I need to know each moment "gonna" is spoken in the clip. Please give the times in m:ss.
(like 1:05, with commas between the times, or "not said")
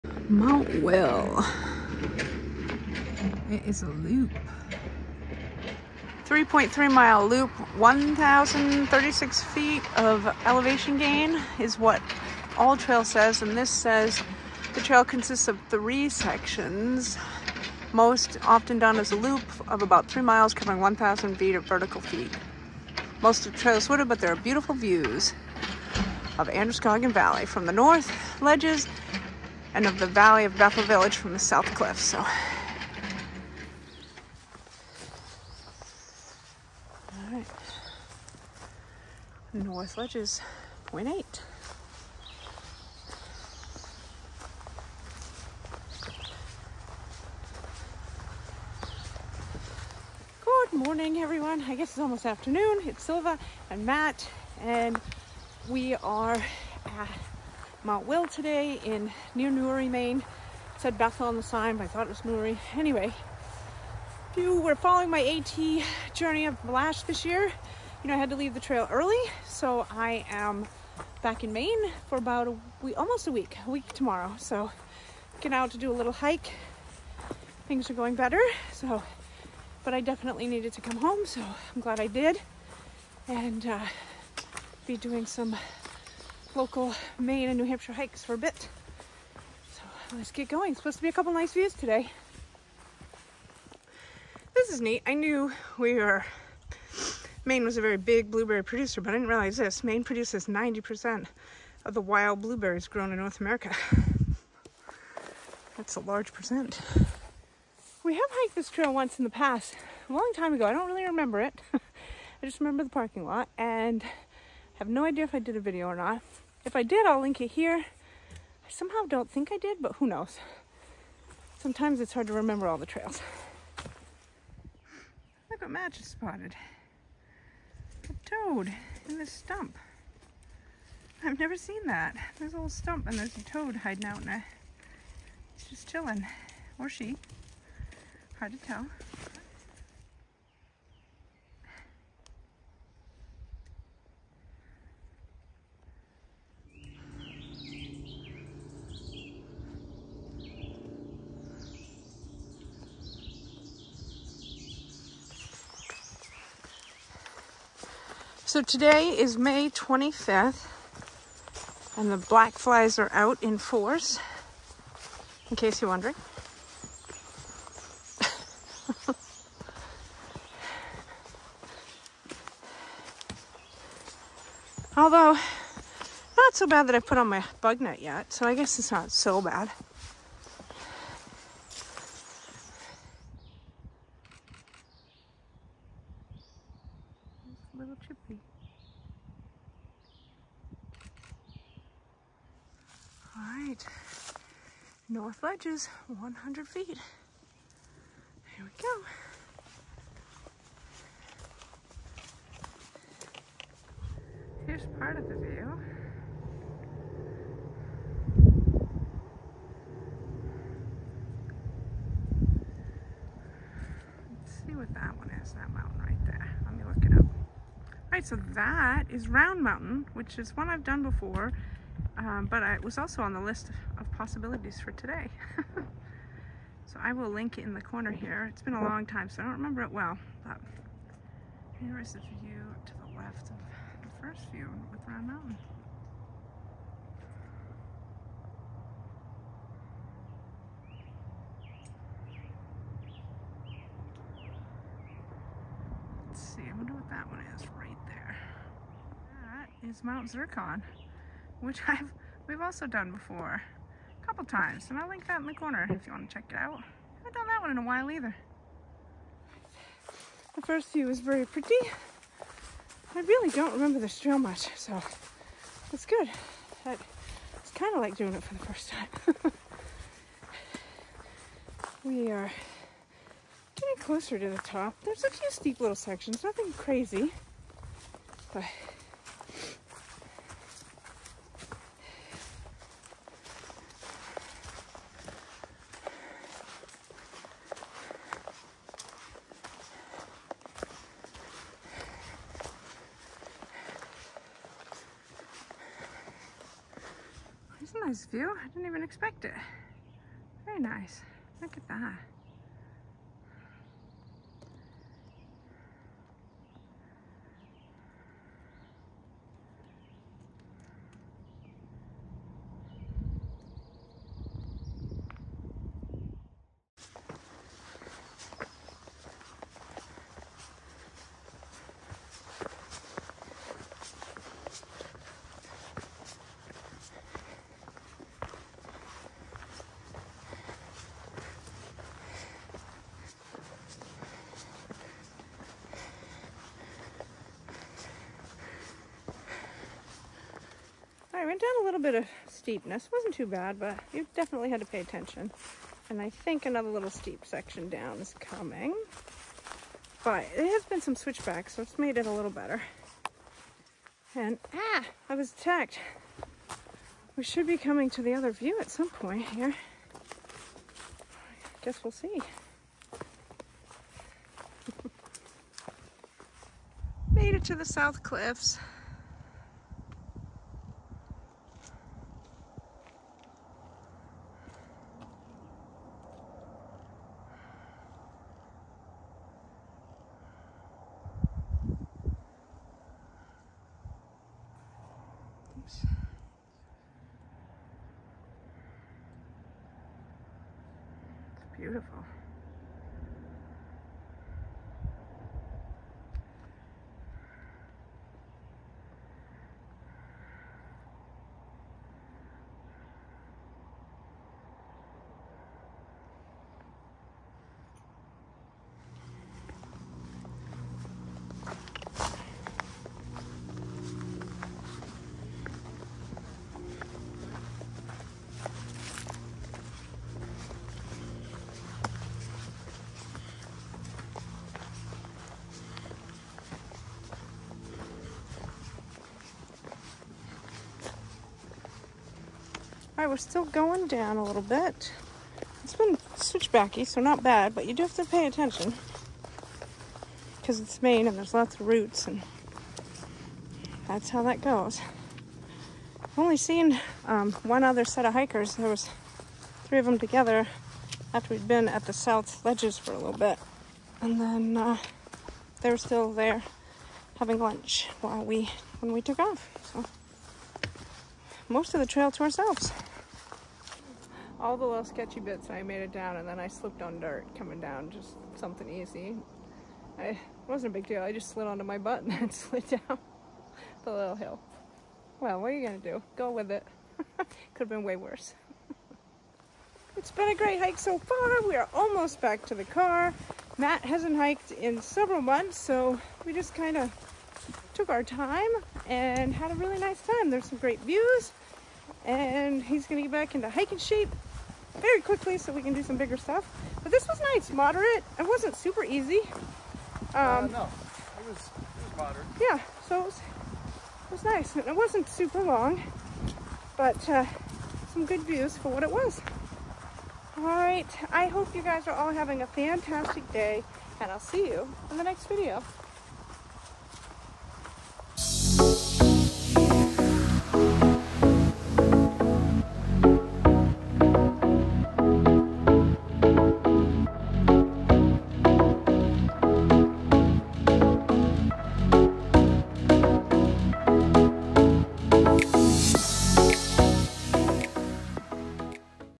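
7:55, 8:13.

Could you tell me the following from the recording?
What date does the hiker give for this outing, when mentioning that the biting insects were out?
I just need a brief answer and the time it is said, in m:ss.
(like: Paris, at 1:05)
May 25th, at 2:39.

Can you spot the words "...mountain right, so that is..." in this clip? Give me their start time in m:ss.
3:35.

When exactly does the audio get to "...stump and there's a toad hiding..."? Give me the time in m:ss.
2:12.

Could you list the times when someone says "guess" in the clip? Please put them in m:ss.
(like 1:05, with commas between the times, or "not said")
0:51, 2:58, 6:01.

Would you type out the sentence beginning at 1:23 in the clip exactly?
And uh, be doing some local Maine and New Hampshire hikes for a bit.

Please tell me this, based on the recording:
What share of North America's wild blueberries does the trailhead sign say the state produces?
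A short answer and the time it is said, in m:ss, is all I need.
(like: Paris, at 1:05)
90%, at 1:40.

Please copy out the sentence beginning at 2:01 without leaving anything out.
Sometimes it's hard to remember all the trails.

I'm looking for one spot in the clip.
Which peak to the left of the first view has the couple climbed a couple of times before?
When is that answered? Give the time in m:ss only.
4:10.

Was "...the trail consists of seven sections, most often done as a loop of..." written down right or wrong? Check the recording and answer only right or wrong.
wrong.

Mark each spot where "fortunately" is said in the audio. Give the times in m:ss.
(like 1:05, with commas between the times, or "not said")
not said.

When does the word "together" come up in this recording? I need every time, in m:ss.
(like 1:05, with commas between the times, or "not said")
7:30.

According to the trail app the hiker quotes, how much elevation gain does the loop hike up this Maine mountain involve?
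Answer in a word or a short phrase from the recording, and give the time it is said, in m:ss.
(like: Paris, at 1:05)
1,036 feet, at 0:07.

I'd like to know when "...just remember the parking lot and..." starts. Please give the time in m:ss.
1:52.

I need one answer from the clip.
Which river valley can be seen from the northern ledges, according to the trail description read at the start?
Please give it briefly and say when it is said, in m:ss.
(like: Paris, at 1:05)
Androscoggin Valley, at 0:26.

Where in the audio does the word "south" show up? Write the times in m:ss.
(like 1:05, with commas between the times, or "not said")
0:31, 6:07, 7:32.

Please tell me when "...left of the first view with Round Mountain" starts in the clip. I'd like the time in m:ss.
3:53.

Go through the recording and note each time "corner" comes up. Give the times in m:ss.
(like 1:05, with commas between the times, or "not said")
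3:47, 4:15.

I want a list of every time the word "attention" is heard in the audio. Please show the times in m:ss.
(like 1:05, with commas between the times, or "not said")
5:45, 7:18.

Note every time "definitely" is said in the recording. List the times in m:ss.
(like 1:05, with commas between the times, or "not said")
1:20, 5:44.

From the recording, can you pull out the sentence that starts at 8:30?
All right, I hope you guys are all having a fantastic day, and I'll see you in the next video.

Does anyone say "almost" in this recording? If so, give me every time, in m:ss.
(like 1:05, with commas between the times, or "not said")
0:51, 1:12, 8:01.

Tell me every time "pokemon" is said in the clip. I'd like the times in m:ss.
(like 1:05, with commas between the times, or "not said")
not said.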